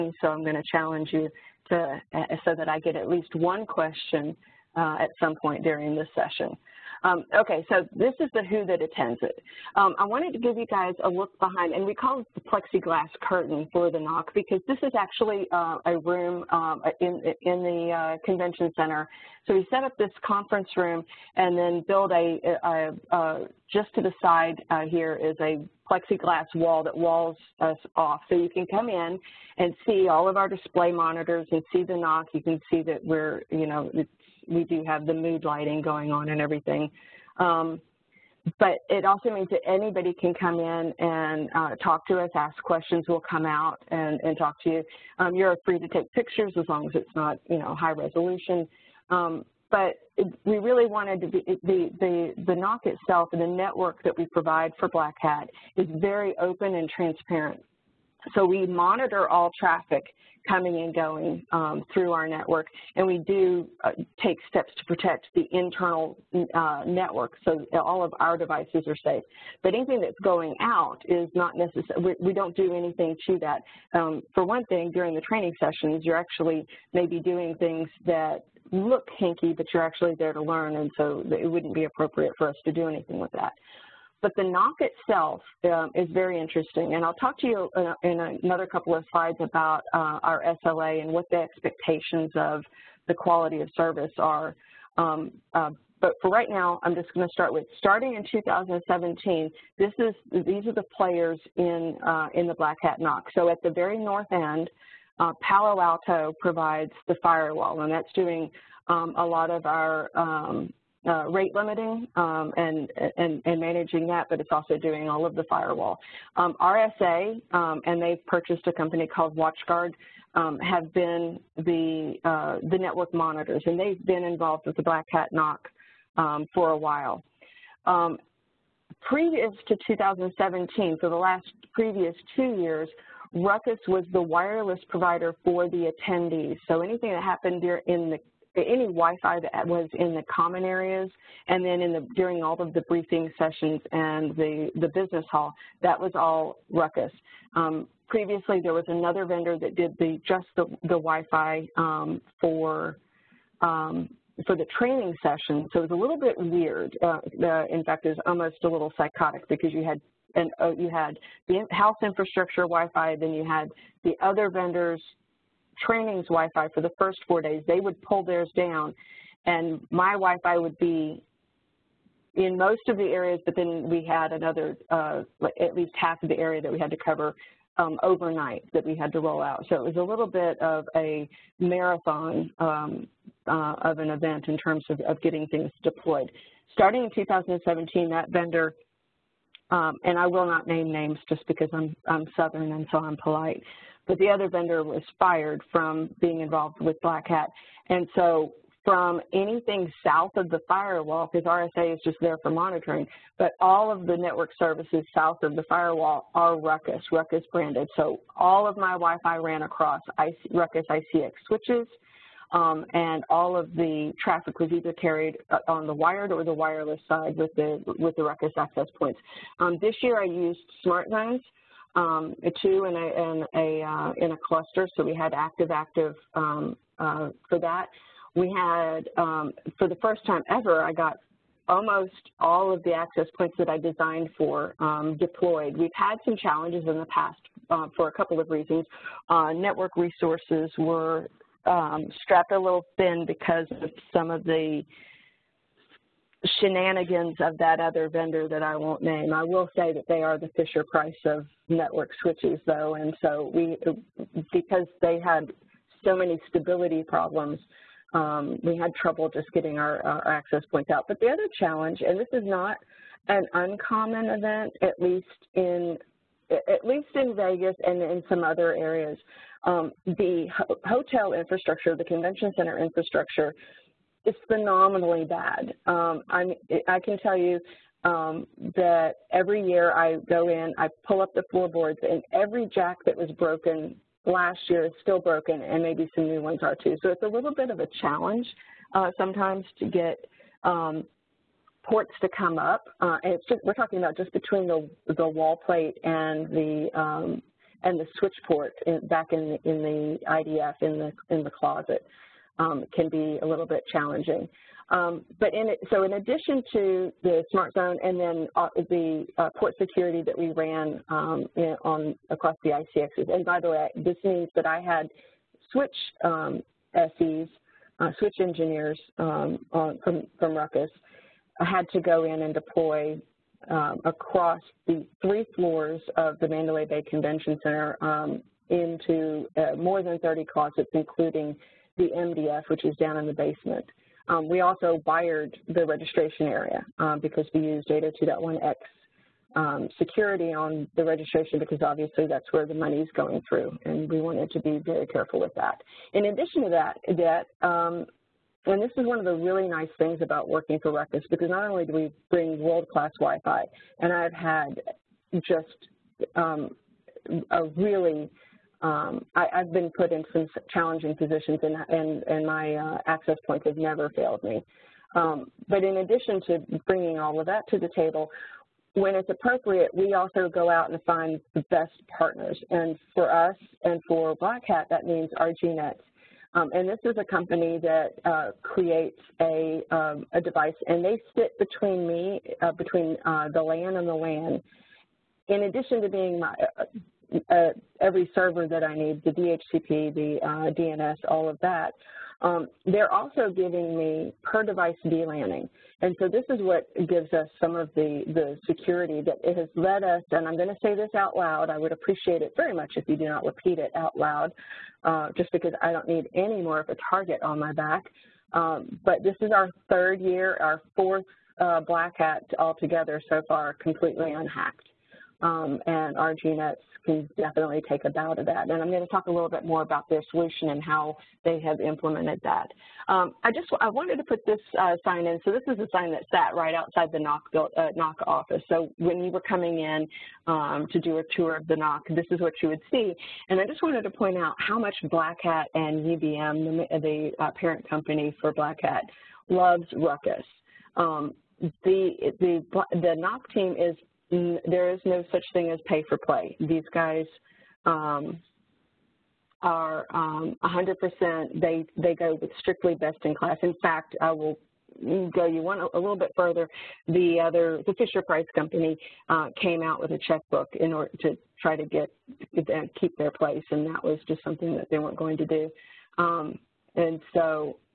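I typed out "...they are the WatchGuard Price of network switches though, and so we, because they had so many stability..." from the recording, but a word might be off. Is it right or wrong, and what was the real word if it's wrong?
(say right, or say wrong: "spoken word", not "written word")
wrong: "Fisher", not "WatchGuard".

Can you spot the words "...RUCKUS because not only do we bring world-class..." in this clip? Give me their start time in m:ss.
5:50.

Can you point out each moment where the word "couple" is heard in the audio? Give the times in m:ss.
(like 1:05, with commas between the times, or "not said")
1:28, 3:58.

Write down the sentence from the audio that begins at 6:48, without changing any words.
Um, but this is our third year, our fourth uh, Black Hat altogether so far, completely unhacked.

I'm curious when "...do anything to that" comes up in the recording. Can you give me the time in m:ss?
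1:12.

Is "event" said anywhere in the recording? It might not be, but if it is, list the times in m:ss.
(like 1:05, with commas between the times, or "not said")
3:04, 4:24.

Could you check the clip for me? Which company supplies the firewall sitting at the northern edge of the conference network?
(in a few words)
Palo Alto.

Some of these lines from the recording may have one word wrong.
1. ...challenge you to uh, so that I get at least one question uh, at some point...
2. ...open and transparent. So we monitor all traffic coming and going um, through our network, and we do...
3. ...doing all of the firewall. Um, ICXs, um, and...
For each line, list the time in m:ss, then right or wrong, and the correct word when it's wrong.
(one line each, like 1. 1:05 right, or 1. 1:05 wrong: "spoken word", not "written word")
1. 0:00 right
2. 0:56 right
3. 1:54 wrong: "RSA", not "ICXs".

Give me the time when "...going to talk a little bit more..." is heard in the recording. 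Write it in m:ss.
6:58.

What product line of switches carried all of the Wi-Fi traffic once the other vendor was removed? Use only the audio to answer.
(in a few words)
Ruckus ICX.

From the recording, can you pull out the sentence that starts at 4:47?
So it's a little bit of a challenge uh, sometimes to get um, ports to come up.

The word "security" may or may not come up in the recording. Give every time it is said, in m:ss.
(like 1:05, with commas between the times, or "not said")
5:09, 5:39, 6:38.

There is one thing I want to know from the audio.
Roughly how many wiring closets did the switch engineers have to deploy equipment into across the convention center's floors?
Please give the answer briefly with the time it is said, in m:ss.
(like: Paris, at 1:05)
More than 30, at 5:29.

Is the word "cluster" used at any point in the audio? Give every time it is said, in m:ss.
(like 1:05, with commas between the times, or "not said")
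3:44.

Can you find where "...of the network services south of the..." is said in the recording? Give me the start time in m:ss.
3:23.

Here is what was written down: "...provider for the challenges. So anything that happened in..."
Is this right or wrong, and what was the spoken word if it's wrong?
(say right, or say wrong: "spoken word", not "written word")
wrong: "attendees", not "challenges".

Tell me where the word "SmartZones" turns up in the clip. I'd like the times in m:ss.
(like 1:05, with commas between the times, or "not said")
3:40, 5:07.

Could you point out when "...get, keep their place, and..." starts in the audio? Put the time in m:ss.
7:41.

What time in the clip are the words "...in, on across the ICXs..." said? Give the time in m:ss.
5:11.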